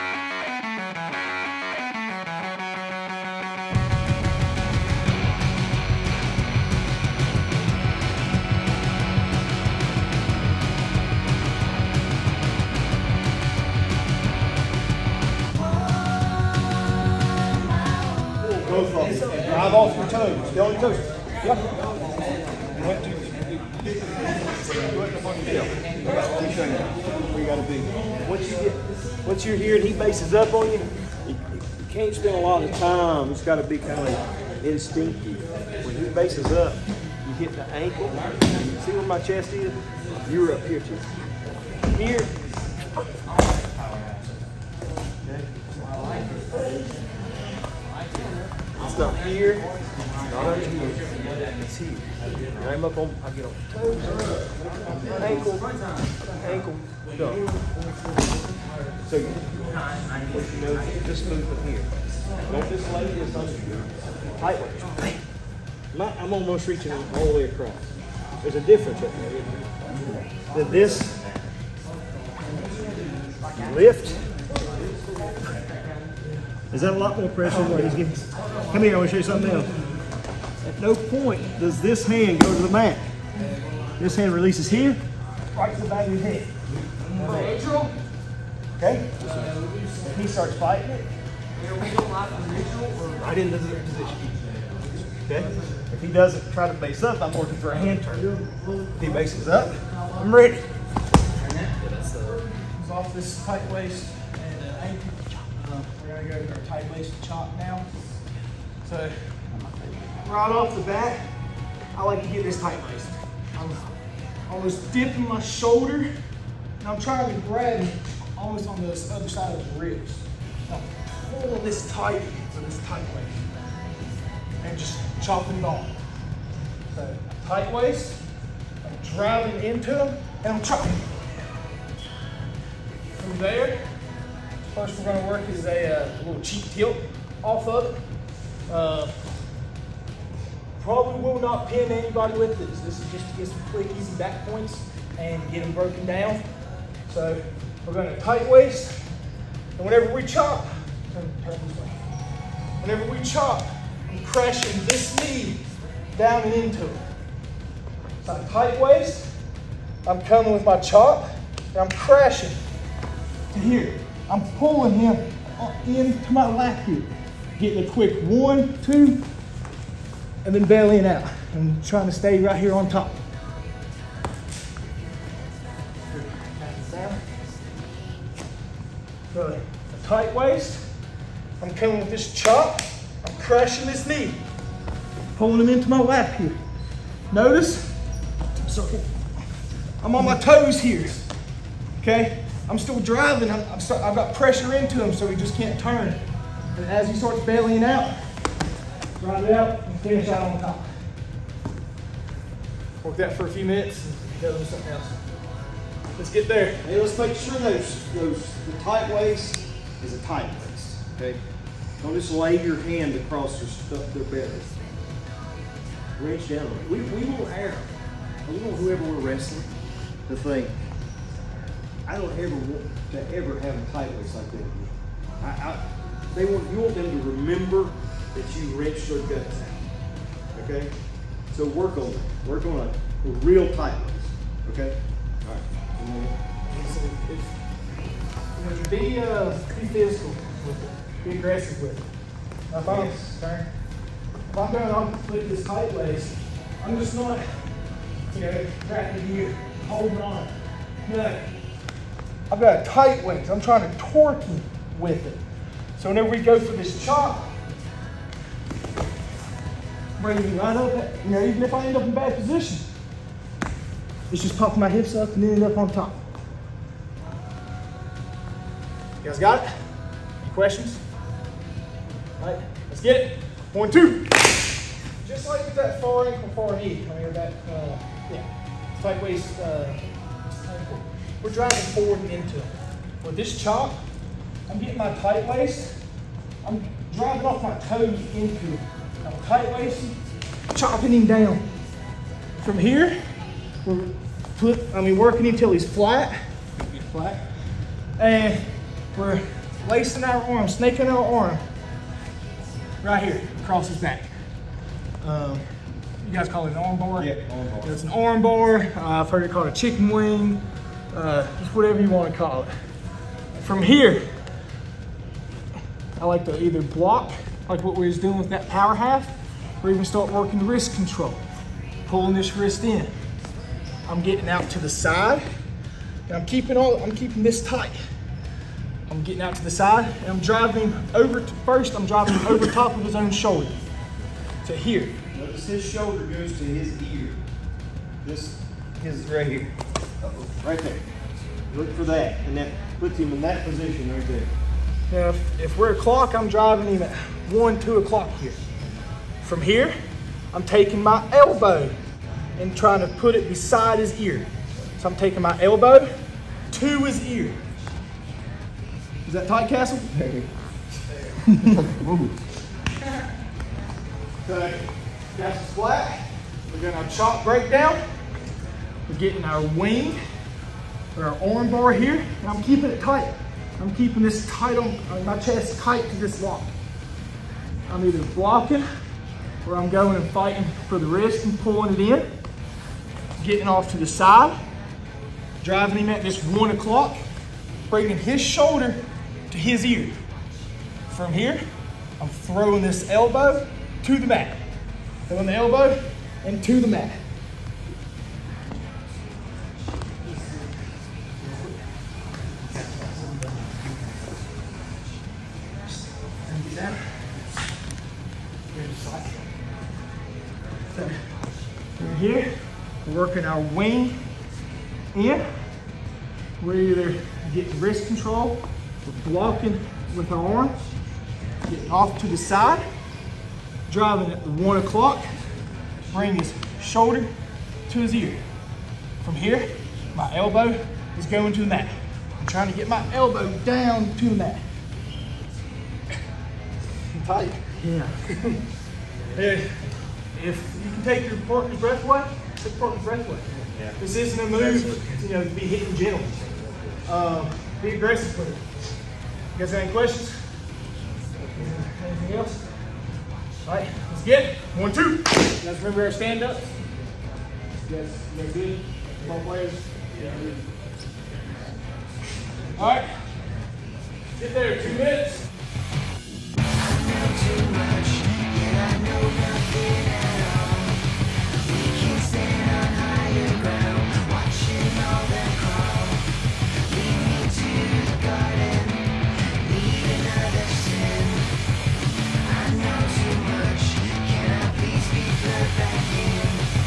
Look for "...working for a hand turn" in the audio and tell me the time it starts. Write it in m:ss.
1:37.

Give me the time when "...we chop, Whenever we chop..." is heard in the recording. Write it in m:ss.
2:30.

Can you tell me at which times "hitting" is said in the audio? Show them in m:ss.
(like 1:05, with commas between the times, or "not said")
7:25.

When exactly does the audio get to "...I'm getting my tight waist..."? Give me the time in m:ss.
4:44.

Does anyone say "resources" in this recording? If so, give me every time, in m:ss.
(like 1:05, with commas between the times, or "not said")
not said.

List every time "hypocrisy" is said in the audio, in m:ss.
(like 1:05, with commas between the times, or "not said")
not said.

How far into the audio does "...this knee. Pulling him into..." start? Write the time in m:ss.
3:03.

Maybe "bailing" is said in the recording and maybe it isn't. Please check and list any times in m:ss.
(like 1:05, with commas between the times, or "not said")
2:50, 3:17.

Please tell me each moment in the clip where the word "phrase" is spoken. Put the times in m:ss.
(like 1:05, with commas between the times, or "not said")
not said.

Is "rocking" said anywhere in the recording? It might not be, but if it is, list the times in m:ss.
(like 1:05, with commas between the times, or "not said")
not said.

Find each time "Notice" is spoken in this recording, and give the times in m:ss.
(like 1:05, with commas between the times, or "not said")
3:07, 5:35.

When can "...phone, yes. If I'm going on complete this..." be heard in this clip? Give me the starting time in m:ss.
4:02.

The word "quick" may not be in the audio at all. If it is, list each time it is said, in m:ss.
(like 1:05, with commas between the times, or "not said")
2:23, 2:47.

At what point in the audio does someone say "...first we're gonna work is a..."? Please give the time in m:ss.
2:14.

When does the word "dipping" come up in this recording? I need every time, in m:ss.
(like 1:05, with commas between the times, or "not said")
1:54.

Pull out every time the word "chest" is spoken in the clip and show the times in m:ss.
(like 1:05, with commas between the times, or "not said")
0:39, 6:15.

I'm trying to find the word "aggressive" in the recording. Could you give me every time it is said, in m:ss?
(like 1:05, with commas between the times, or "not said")
4:01, 7:27.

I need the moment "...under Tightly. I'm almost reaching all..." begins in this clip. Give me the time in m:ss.
1:03.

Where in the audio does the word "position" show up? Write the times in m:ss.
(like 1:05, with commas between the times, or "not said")
1:33, 4:22, 5:43.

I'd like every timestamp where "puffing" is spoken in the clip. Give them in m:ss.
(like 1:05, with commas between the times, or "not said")
4:24.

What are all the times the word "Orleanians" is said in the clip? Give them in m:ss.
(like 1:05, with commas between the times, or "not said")
not said.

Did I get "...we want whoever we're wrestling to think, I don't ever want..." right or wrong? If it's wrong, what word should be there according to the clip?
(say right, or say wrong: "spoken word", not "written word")
right.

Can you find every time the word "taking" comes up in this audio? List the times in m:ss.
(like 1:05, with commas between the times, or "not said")
5:50, 5:55.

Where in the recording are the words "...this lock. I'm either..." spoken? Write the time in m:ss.
6:16.